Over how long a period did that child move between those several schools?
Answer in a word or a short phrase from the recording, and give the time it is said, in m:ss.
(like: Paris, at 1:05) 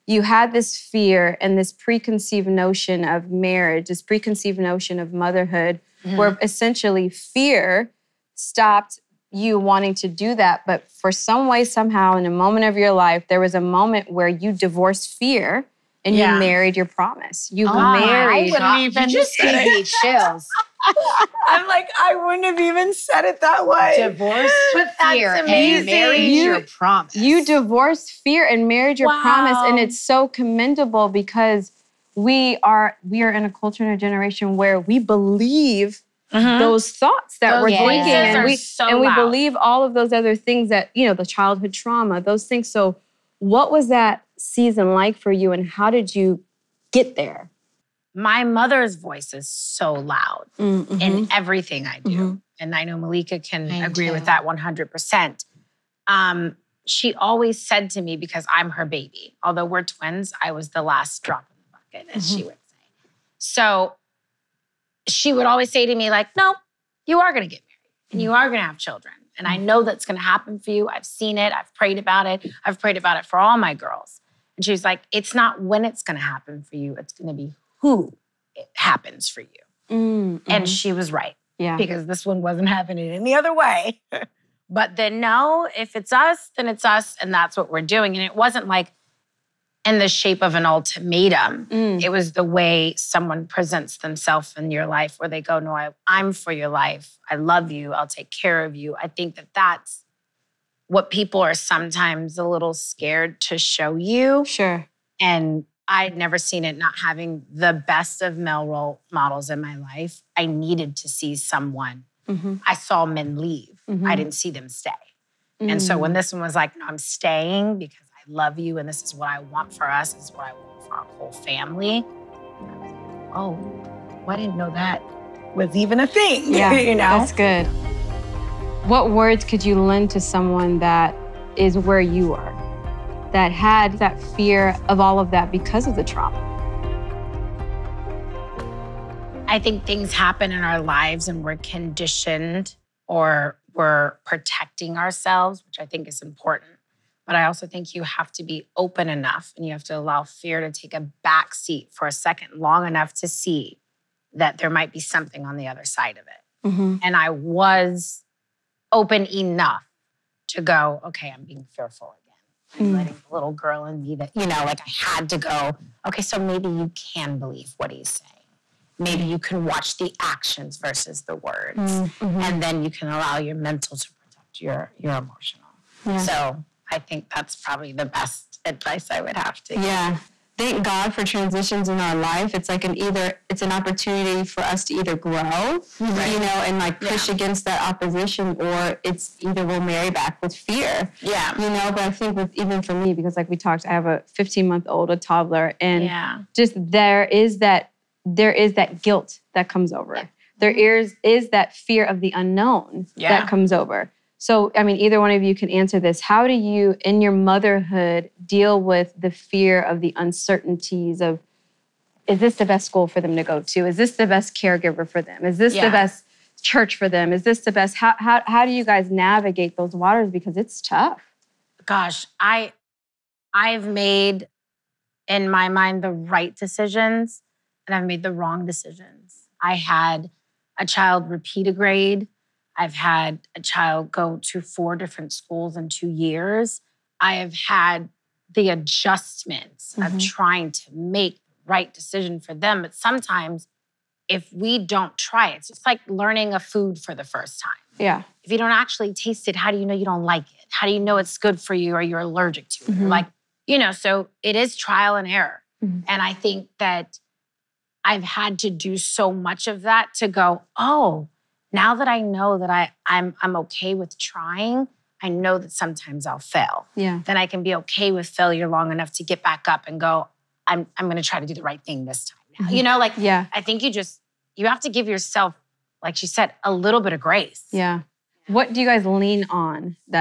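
2 years, at 3:55.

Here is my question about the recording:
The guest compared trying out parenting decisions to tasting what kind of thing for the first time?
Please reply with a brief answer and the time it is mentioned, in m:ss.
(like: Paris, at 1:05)
A food, at 4:06.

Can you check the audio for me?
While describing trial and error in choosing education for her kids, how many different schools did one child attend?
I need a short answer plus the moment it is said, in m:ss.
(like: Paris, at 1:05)
4, at 3:54.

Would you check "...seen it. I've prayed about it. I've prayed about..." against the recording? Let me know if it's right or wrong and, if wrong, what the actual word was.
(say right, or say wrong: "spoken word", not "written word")
right.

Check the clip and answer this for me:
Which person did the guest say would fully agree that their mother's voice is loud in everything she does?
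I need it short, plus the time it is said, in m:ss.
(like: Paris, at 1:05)
Malika, at 0:52.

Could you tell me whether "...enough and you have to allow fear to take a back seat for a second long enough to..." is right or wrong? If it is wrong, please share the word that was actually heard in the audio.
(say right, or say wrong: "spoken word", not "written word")
right.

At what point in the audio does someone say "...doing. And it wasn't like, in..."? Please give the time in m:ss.
1:27.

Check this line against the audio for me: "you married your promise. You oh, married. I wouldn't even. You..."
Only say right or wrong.
right.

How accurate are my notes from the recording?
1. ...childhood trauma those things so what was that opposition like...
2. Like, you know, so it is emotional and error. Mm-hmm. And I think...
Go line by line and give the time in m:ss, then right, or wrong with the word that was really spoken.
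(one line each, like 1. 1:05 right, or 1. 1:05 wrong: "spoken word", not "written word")
1. 0:41 wrong: "season", not "opposition"
2. 4:13 wrong: "trial", not "emotional".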